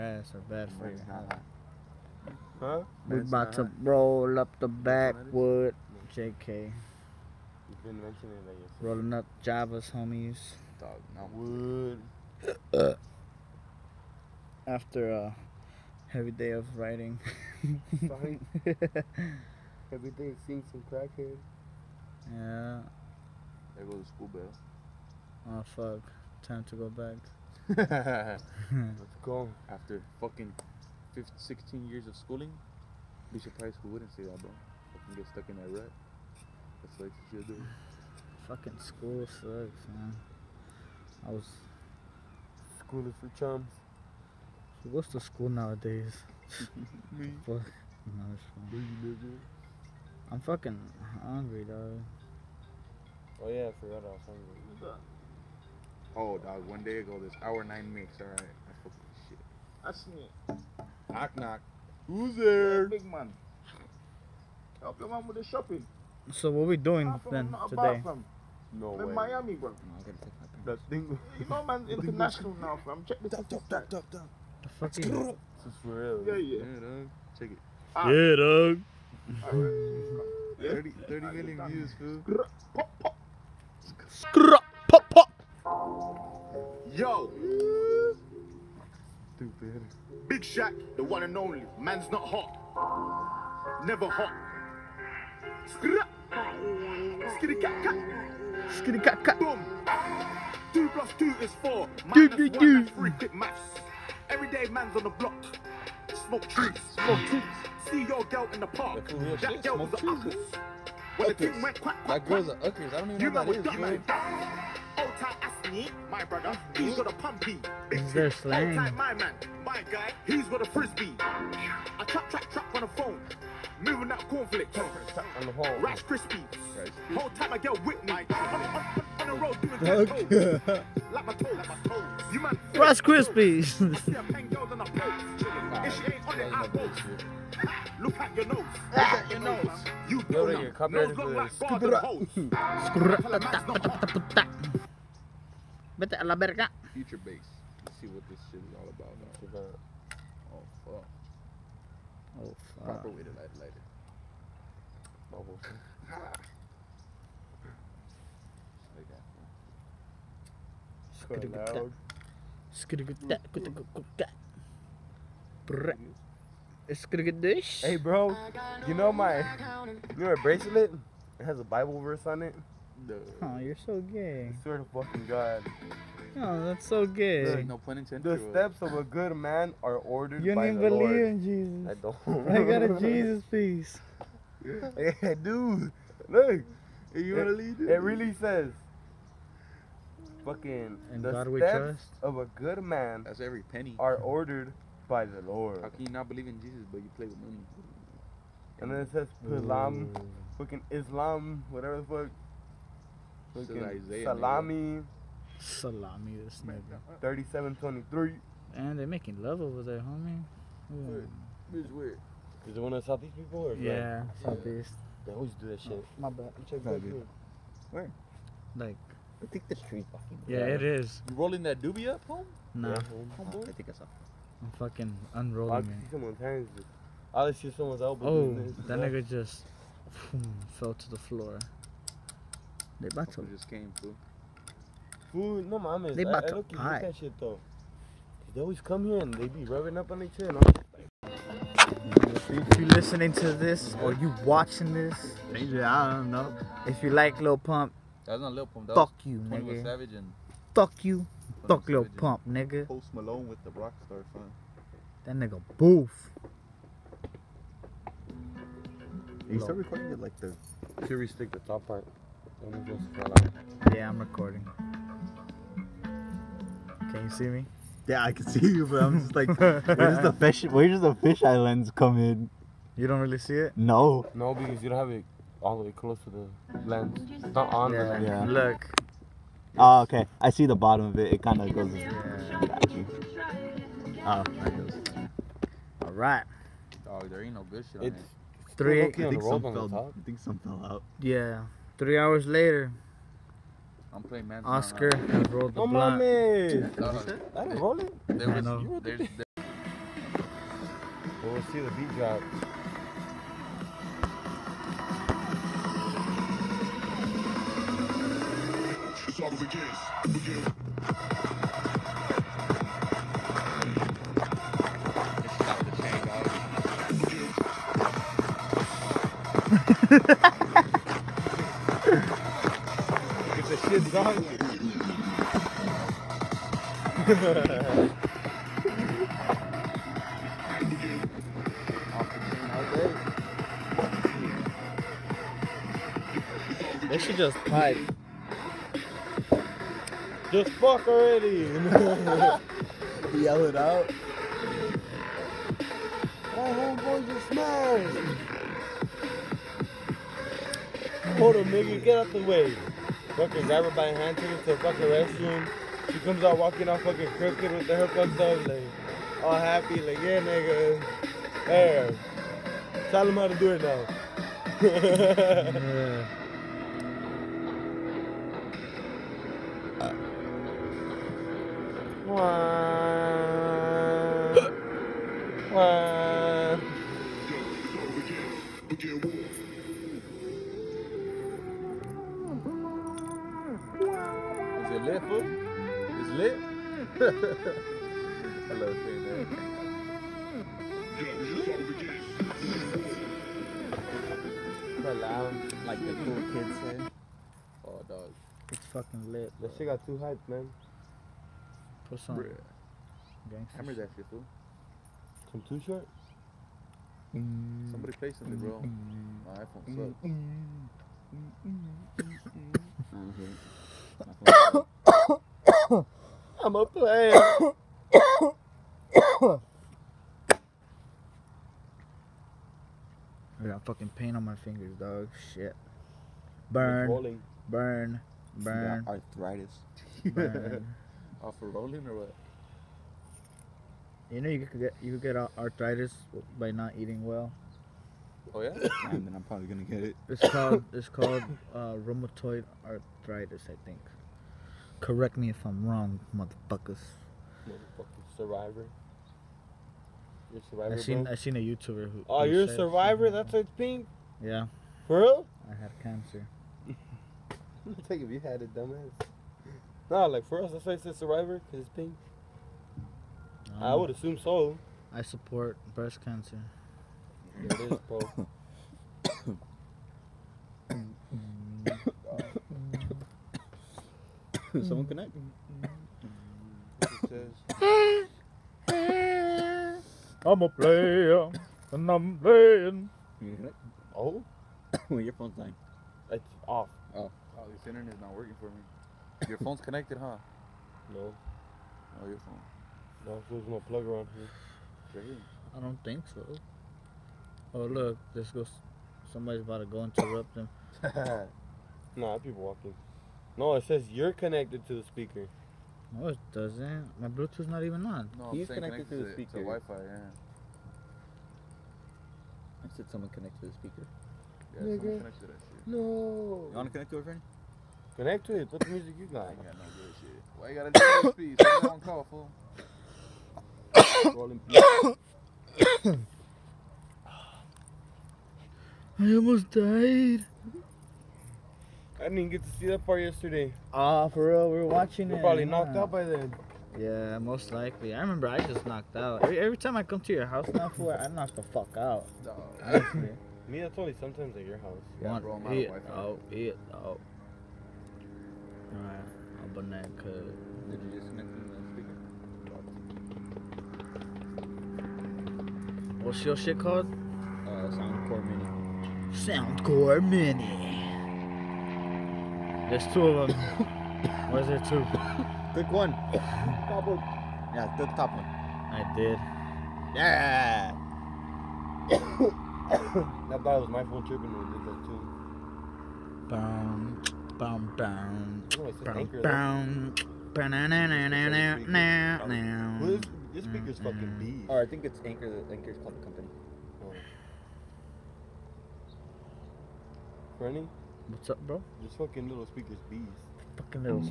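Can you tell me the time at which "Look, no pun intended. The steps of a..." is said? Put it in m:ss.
2:57.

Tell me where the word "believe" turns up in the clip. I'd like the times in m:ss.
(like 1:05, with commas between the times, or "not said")
3:00, 3:16.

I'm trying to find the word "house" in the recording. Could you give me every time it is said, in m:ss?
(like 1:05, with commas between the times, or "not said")
9:00, 9:04.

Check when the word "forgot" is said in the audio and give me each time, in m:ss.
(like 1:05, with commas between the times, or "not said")
0:53.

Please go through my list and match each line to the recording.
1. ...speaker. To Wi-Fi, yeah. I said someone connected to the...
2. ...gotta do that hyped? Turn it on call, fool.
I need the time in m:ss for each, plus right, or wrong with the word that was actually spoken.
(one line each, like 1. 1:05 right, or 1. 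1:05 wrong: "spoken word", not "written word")
1. 8:29 right
2. 8:40 wrong: "speed", not "hyped".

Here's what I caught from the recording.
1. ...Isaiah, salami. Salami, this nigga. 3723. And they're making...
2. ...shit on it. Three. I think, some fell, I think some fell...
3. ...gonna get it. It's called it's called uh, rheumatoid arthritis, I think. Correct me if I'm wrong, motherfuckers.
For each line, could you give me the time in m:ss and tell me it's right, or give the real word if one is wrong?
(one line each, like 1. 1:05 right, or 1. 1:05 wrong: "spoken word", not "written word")
1. 3:23 right
2. 4:47 right
3. 7:19 right.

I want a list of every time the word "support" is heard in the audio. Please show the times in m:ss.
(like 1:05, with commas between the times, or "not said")
7:45.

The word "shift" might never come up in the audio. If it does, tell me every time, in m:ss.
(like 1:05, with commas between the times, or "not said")
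not said.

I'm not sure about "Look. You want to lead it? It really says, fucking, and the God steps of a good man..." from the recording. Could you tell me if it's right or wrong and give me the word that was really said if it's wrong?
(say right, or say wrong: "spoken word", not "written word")
right.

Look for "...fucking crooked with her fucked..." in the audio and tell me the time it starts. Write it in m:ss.
5:57.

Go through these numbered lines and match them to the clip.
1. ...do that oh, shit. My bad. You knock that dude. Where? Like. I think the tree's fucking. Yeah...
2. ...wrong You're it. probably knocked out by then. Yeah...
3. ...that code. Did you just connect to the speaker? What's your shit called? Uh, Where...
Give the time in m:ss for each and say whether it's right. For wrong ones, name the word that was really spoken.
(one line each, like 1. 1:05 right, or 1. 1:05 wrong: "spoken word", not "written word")
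1. 3:35 wrong: "check", not "knock"
2. 8:54 wrong: "watching", not "wrong"
3. 9:09 wrong: "Soundcore", not "Where".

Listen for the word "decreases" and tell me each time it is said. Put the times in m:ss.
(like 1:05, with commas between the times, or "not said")
not said.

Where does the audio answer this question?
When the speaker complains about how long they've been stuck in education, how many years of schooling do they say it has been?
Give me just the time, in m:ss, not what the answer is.
0:31.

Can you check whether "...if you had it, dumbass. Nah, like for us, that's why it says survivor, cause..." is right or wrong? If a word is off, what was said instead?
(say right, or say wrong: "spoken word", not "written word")
right.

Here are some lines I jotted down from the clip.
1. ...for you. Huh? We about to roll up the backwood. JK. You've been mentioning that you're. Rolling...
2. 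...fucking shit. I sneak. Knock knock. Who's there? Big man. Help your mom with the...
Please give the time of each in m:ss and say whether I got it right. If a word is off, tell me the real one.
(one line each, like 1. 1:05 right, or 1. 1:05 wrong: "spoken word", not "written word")
1. 0:00 right
2. 0:58 right.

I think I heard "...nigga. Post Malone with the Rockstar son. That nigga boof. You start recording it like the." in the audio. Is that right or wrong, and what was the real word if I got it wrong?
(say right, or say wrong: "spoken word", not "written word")
right.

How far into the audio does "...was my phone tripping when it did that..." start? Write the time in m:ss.
9:33.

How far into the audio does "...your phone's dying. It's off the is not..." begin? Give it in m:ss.
8:05.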